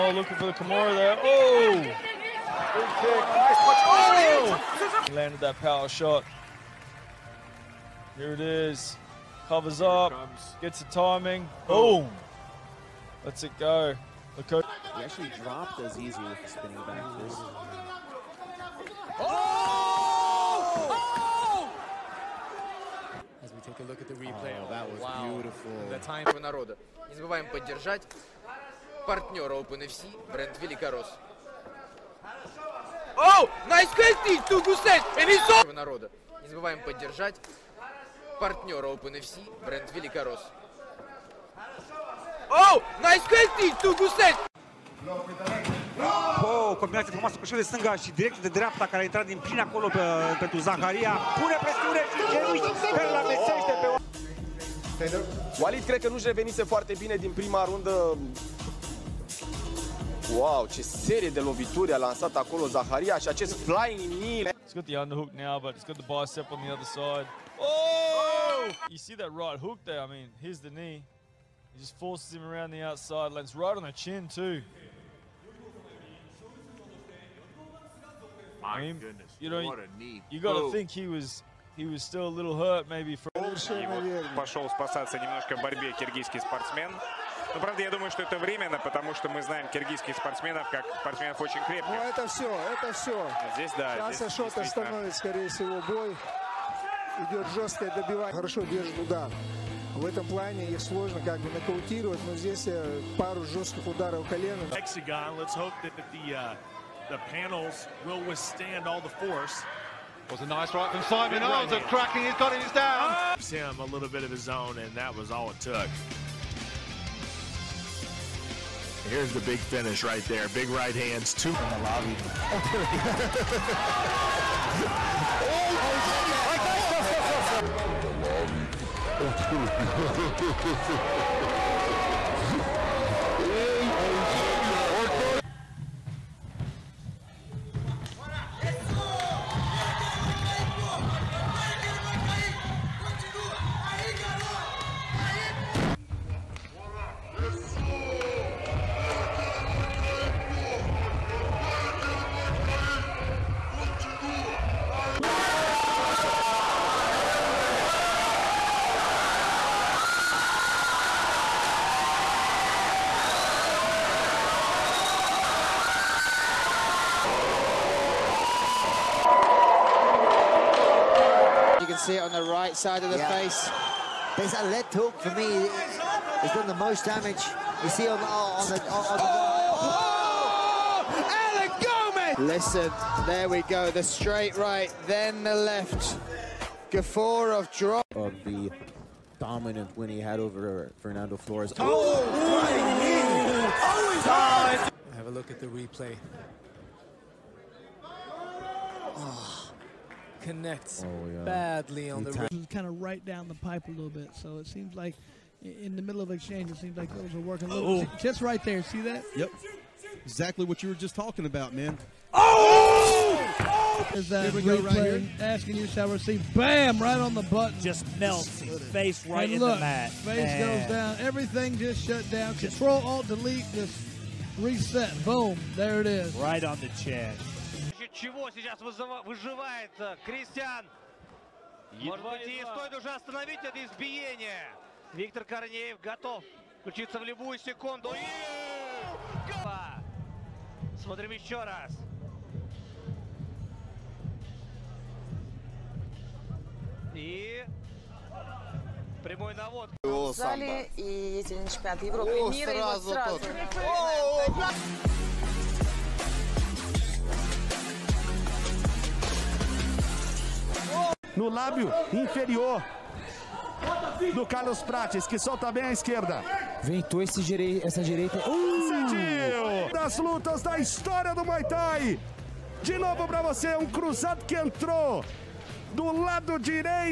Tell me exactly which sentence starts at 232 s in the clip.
и стоит уже остановить это избиение.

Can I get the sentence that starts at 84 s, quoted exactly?
Пошел спасаться немножко в борьбе киргизский спортсмен.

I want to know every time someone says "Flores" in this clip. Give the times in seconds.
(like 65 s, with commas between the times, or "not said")
191 s.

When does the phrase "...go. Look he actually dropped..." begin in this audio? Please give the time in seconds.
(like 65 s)
13 s.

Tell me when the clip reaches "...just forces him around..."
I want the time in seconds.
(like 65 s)
71 s.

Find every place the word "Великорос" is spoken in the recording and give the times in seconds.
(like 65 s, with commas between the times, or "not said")
30 s, 39 s.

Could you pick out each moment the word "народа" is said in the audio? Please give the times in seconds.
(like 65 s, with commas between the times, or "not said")
26 s, 35 s.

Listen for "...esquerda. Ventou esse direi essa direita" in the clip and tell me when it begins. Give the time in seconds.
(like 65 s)
265 s.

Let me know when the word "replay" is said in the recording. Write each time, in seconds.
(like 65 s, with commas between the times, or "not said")
24 s, 195 s.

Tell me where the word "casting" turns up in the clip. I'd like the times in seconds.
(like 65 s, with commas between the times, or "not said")
33 s, 43 s.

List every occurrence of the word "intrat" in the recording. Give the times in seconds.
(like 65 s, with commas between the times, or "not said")
49 s.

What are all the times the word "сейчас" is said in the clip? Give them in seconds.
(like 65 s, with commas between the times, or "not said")
93 s, 228 s.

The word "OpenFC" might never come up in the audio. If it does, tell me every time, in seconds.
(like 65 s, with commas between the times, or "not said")
29 s, 38 s.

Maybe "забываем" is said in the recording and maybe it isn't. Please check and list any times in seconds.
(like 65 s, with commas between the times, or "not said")
27 s, 36 s.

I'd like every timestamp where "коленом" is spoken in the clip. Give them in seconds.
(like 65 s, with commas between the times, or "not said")
104 s.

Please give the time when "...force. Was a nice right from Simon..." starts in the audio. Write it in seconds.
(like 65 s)
109 s.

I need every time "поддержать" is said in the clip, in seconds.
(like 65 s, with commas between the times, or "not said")
27 s, 36 s.